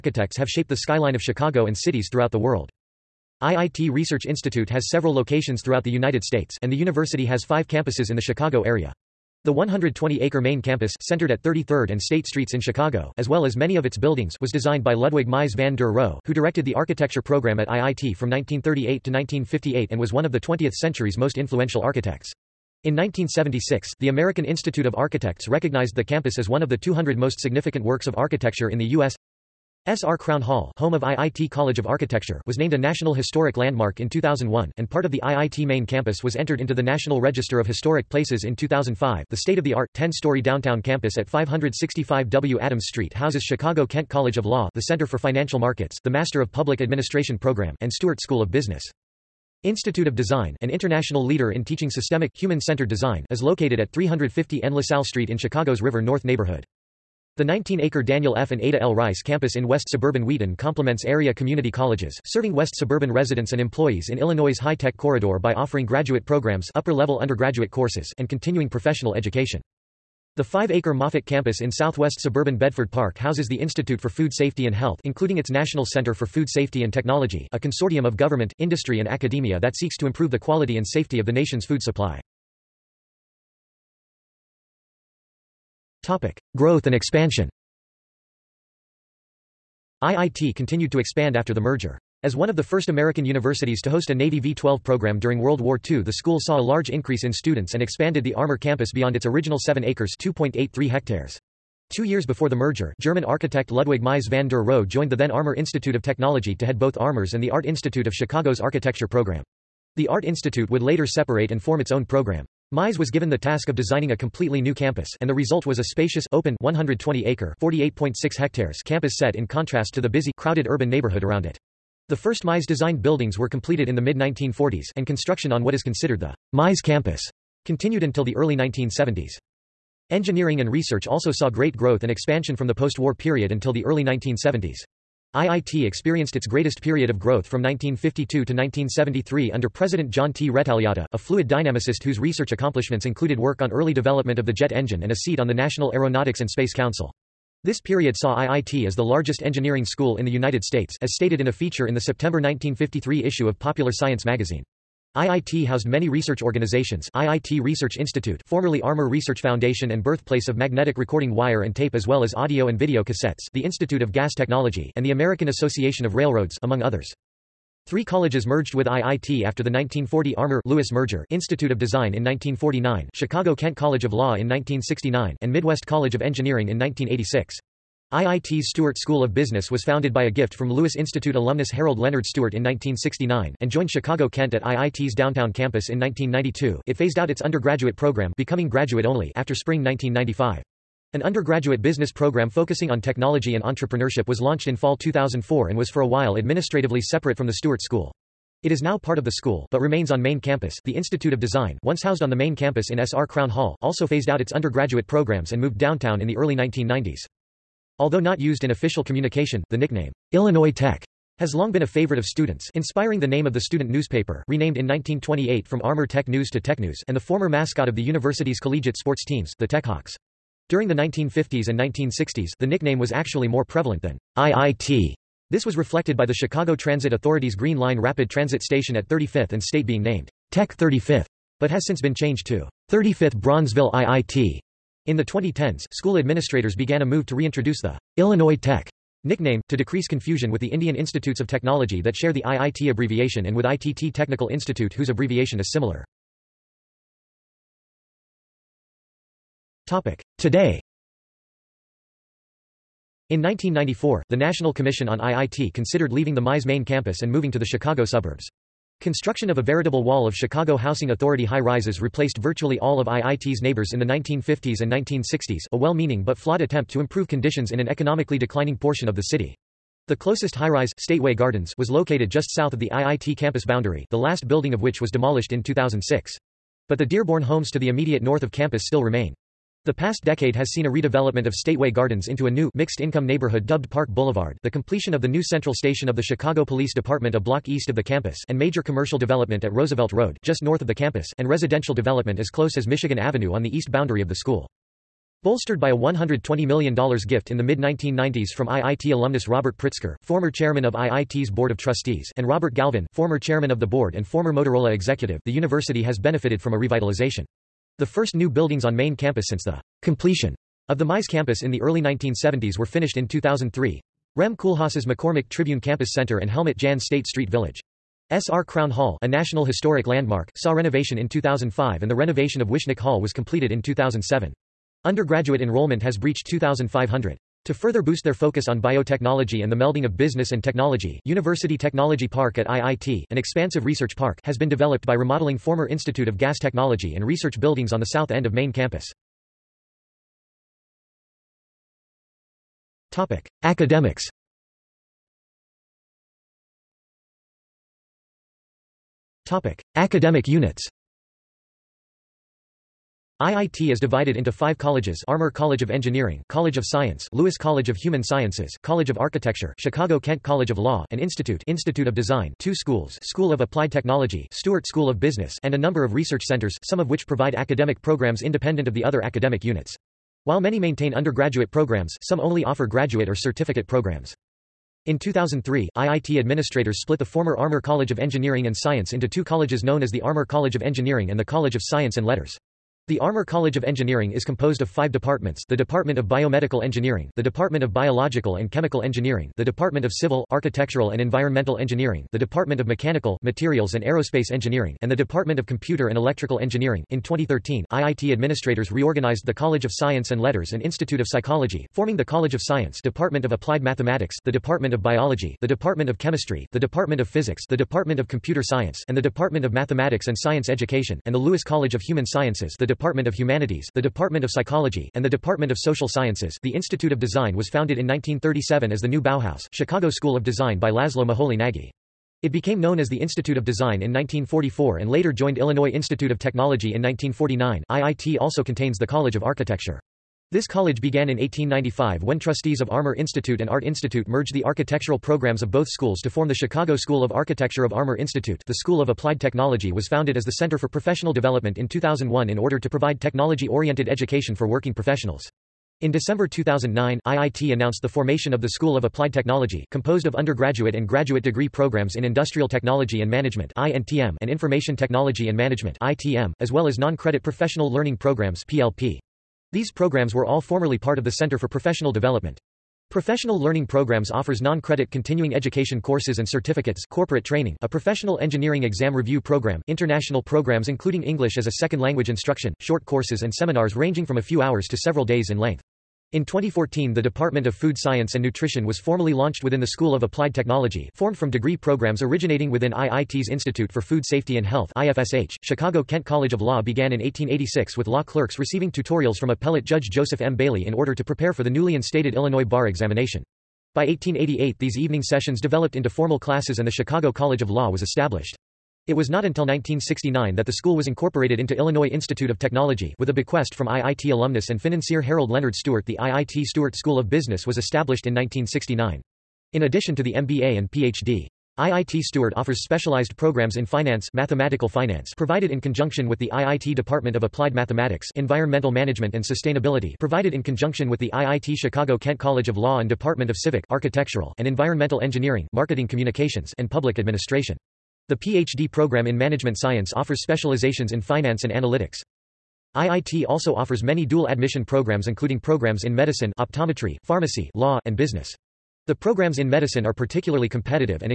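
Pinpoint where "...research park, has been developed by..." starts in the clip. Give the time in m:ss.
5:33.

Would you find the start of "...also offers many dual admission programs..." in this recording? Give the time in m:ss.
8:53.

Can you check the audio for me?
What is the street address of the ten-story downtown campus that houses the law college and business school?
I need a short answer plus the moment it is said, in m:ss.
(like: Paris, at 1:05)
565 W. Adams Street, at 0:41.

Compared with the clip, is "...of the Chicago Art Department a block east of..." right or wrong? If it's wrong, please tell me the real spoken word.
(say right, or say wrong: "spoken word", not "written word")
wrong: "Police", not "Art".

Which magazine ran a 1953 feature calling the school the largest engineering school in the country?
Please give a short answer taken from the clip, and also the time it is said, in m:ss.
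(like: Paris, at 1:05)
Popular Science, at 2:33.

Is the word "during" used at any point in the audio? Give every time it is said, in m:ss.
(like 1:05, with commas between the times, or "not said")
1:35, 3:40.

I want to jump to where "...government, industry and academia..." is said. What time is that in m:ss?
1:18.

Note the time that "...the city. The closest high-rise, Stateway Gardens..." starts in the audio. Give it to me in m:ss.
4:29.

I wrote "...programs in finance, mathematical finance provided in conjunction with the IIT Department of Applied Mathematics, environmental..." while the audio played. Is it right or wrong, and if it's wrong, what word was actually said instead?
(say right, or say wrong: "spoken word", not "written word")
right.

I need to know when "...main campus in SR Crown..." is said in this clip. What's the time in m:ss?
3:22.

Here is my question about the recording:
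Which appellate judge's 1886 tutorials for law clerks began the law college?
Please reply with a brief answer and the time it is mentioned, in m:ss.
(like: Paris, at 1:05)
Joseph M. Bailey, at 8:10.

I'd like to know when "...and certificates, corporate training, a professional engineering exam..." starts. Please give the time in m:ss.
7:46.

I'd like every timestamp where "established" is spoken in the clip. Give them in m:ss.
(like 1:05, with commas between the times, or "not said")
8:18, 8:27.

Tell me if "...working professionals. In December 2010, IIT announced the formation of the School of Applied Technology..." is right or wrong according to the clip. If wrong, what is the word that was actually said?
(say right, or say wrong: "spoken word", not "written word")
wrong: "2009", not "2010".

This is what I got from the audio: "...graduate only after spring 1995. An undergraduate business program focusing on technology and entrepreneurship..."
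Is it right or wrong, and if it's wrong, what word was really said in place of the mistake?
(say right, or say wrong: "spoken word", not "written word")
right.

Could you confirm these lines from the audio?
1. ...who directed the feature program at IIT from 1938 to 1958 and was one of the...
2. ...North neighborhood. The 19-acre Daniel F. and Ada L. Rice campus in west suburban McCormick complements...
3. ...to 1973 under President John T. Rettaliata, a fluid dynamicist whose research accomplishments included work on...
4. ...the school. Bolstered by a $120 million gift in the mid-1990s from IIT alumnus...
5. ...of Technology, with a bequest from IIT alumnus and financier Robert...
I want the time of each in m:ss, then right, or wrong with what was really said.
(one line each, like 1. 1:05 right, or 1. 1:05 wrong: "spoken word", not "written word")
1. 0:16 wrong: "architecture", not "feature"
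2. 0:56 wrong: "Wheaton", not "McCormick"
3. 2:18 right
4. 4:54 right
5. 8:22 wrong: "Harold", not "Robert".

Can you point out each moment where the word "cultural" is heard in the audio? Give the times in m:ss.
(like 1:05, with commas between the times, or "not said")
not said.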